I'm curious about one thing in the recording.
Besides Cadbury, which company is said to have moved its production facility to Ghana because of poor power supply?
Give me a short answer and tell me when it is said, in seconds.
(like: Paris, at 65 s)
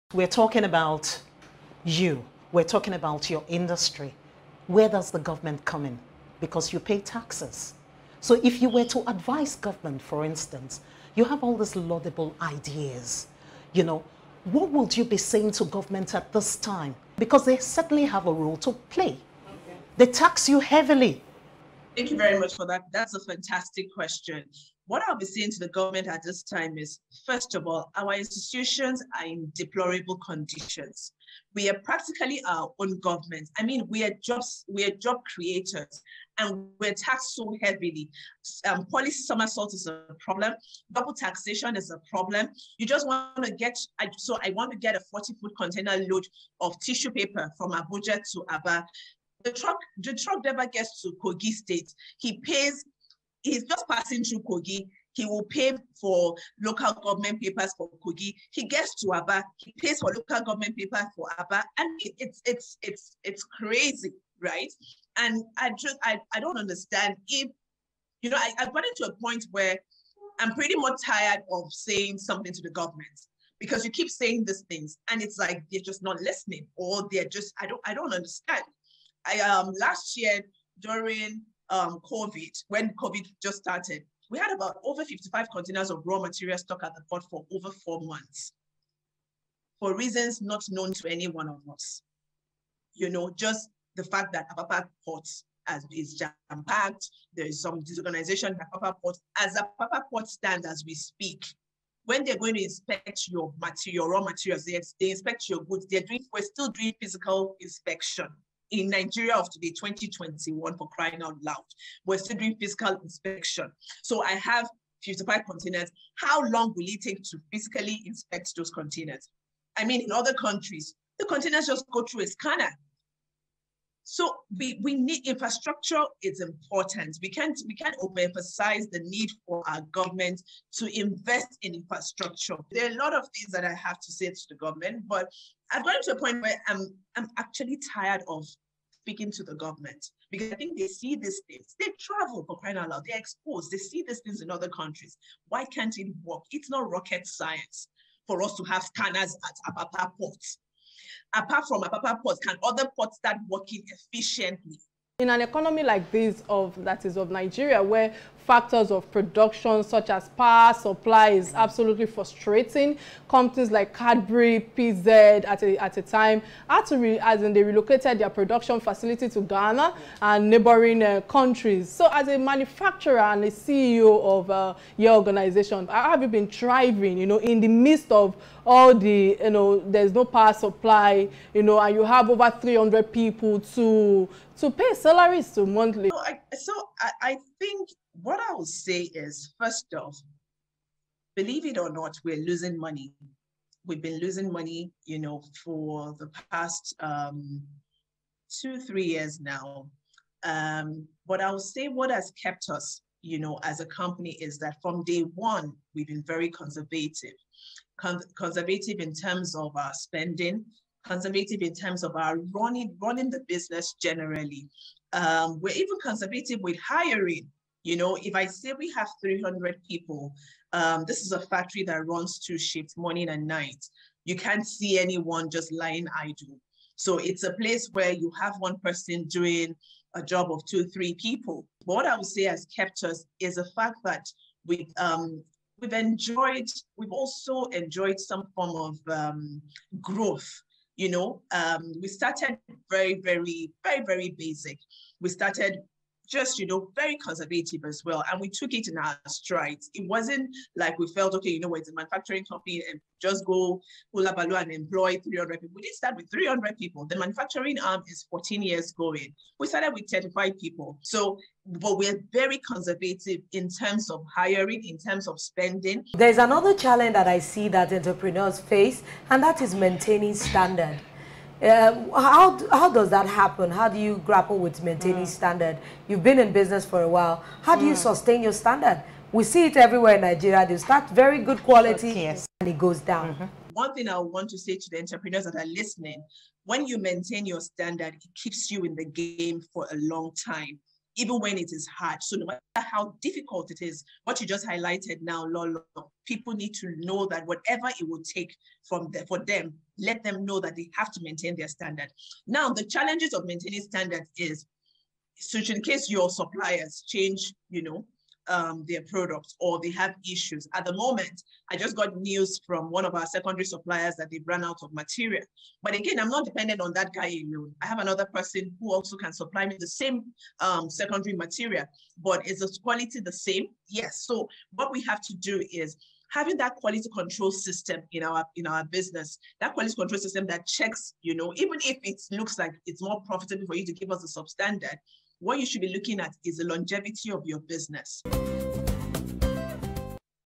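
PZ, at 164 s.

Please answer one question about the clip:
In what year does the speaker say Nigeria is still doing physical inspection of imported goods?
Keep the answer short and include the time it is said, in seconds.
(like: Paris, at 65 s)
2021, at 109 s.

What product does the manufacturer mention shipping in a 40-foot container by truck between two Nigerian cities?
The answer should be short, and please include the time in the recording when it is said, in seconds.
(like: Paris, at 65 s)
Tissue paper, at 46 s.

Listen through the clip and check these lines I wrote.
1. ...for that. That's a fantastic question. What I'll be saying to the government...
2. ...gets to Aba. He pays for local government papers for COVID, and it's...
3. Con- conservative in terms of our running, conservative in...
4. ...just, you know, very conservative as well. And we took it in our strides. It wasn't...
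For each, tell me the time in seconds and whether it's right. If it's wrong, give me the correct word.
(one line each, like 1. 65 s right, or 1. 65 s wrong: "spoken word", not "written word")
1. 22 s right
2. 58 s wrong: "Aba", not "COVID"
3. 207 s wrong: "spending", not "running"
4. 246 s right.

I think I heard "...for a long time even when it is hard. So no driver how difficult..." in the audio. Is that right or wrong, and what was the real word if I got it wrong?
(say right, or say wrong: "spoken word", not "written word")
wrong: "matter", not "driver".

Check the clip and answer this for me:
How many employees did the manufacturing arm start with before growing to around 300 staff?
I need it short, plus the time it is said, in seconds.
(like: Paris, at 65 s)
35, at 260 s.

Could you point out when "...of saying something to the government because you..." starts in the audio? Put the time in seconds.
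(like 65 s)
71 s.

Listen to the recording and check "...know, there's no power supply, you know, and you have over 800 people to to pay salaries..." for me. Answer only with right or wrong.
wrong.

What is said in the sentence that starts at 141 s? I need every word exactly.
They travel for crying out loud.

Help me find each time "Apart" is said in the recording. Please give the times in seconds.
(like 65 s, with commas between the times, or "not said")
151 s.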